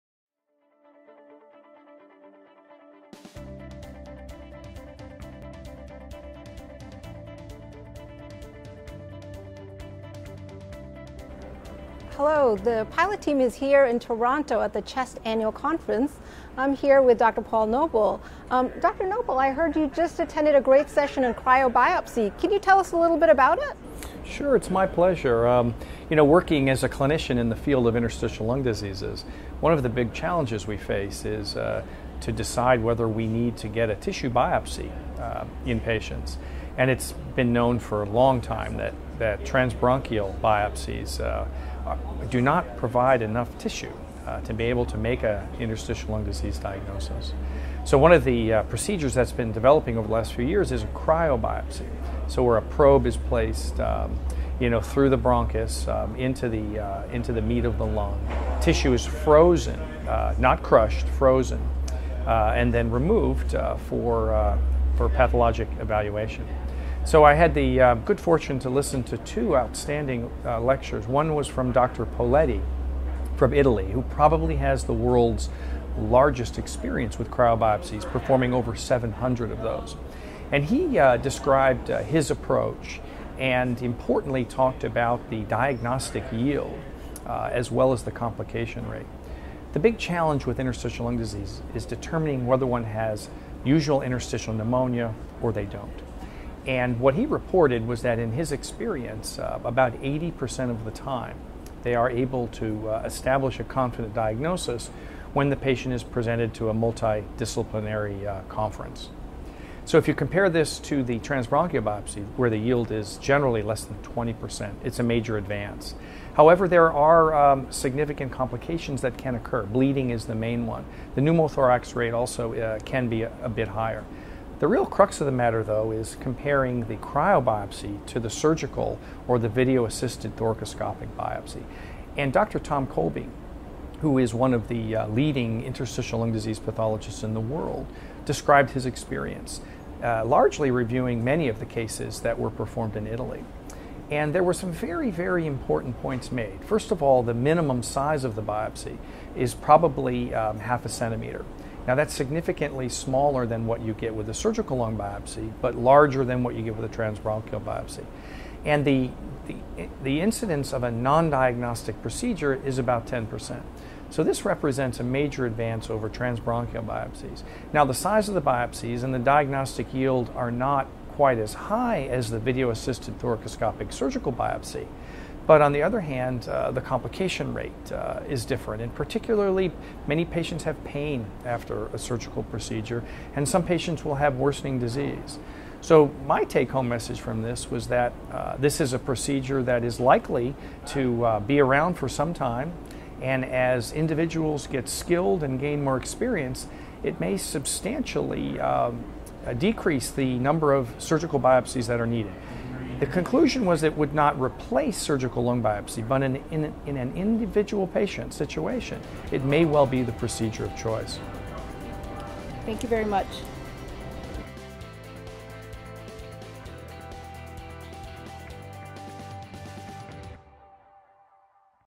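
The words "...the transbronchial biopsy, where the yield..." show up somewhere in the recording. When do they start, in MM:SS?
01:51.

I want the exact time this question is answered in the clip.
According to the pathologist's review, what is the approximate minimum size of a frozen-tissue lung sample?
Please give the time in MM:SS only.
02:30.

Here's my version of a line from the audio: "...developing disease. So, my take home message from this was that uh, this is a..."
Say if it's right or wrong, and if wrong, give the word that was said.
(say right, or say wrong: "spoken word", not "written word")
wrong: "worsening", not "developing".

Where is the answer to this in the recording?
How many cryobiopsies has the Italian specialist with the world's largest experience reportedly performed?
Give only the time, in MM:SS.
01:18.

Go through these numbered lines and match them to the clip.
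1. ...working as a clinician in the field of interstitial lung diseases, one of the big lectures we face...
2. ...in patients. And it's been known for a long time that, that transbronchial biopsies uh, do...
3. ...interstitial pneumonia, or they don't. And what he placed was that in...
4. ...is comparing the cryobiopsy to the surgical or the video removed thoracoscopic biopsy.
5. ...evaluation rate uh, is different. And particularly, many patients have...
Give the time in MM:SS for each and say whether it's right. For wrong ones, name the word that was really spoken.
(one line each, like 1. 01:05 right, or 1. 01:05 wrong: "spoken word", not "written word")
1. 00:26 wrong: "challenges", not "lectures"
2. 00:35 right
3. 01:34 wrong: "reported", not "placed"
4. 02:05 wrong: "assisted", not "removed"
5. 02:56 wrong: "complication", not "evaluation".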